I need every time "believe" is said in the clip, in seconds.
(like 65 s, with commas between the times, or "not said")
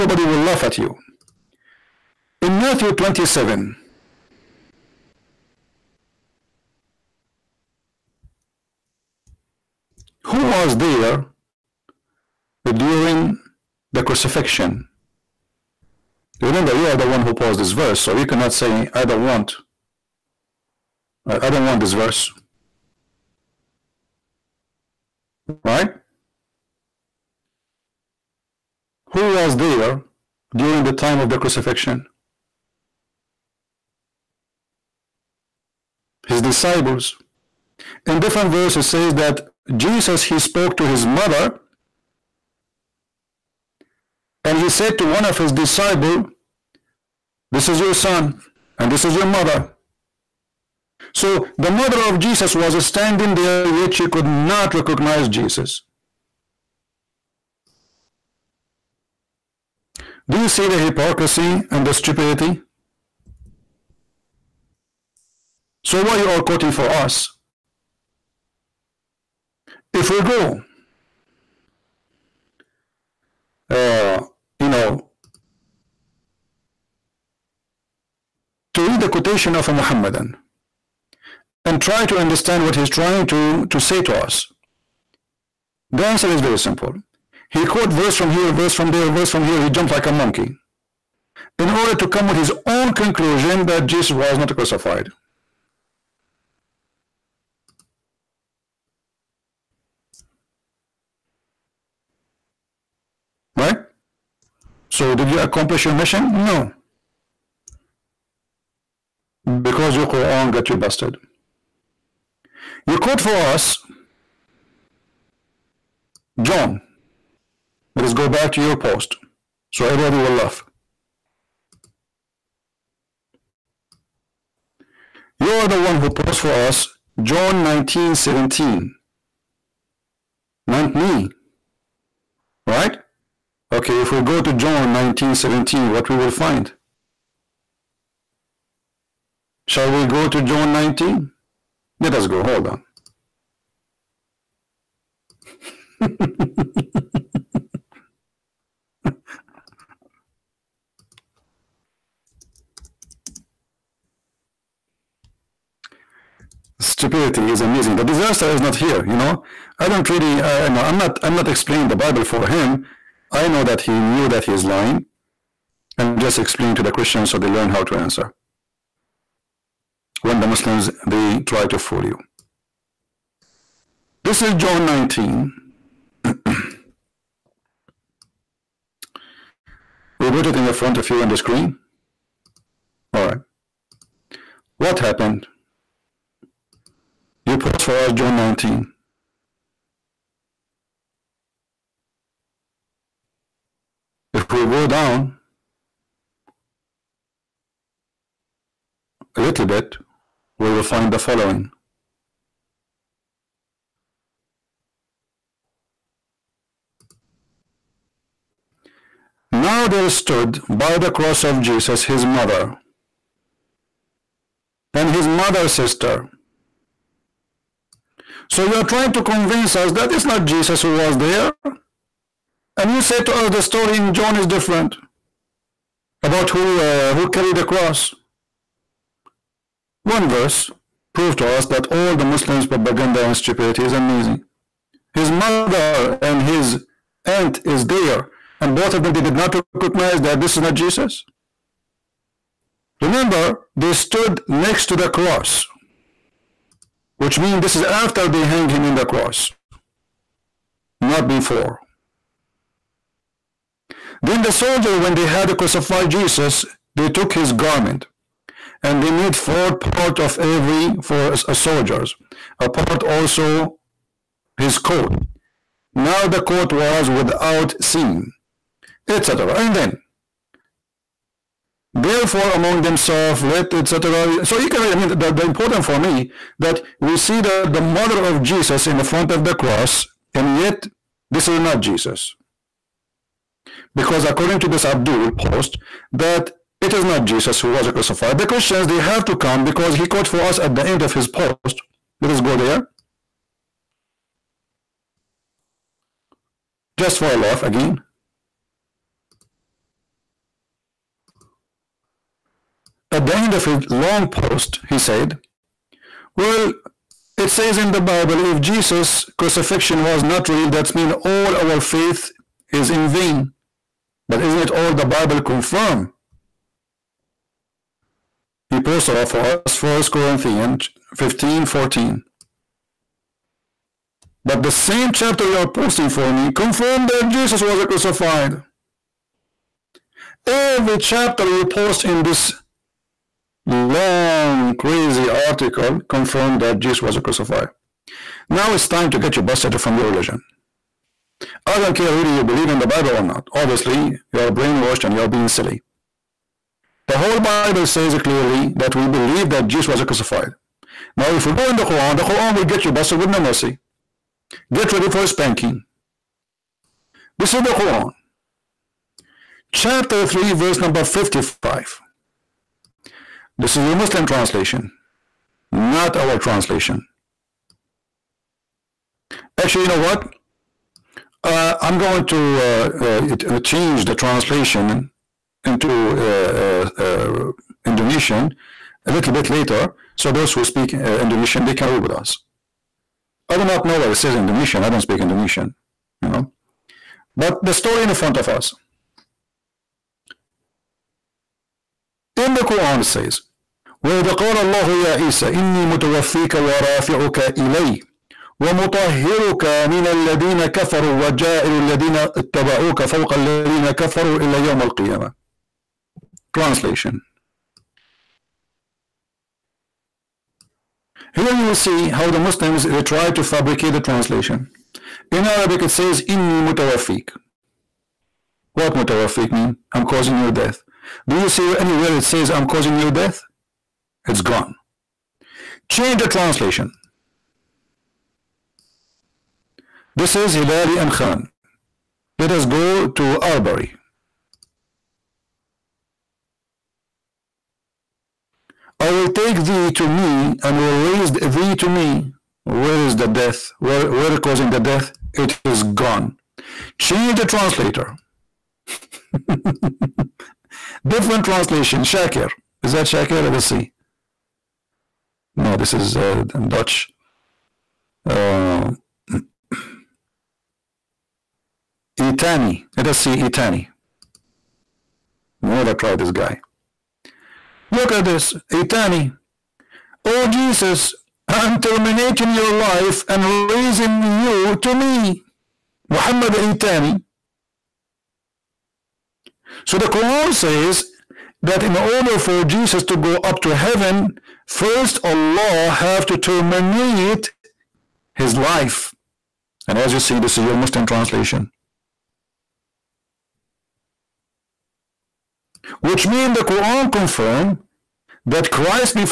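342 s, 349 s.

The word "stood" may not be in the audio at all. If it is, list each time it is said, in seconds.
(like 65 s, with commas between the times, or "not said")
210 s, 243 s.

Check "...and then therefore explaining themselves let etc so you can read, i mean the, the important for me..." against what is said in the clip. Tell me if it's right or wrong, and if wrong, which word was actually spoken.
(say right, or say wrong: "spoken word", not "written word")
wrong: "among", not "explaining".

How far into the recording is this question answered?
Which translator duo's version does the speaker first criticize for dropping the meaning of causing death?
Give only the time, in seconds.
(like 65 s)
430 s.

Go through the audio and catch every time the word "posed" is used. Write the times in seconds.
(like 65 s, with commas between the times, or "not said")
17 s, 126 s.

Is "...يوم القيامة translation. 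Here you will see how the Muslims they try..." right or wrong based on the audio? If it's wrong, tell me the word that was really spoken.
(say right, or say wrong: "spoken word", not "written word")
right.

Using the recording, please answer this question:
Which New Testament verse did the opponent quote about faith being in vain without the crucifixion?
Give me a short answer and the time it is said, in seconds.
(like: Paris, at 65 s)
1 Corinthians 15:14, at 319 s.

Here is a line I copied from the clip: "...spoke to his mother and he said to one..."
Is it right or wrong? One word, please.
right.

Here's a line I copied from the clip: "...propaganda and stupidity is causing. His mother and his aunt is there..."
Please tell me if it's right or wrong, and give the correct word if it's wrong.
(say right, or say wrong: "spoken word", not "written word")
wrong: "amazing", not "causing".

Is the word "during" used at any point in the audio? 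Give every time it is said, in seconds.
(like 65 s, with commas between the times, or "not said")
12 s, 30 s.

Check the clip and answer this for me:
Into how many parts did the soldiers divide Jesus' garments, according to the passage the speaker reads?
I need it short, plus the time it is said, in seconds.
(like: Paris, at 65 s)
4, at 259 s.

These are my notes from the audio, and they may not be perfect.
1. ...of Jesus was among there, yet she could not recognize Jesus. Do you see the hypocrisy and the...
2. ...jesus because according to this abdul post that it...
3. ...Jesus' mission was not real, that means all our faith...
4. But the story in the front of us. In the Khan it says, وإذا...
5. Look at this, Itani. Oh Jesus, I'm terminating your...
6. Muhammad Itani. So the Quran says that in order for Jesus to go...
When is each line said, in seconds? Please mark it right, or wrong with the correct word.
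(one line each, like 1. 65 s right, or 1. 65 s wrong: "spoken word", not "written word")
1. 52 s wrong: "standing", not "among"
2. 281 s right
3. 308 s wrong: "crucifixion", not "mission"
4. 387 s wrong: "Quran", not "Khan"
5. 467 s right
6. 476 s right.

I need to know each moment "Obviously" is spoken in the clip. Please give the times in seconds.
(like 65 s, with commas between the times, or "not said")
343 s.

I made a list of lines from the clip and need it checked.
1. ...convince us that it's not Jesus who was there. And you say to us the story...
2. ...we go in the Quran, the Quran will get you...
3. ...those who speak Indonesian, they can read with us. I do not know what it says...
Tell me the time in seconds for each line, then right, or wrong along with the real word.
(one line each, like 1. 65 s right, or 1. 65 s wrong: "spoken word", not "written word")
1. 219 s right
2. 351 s right
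3. 380 s right.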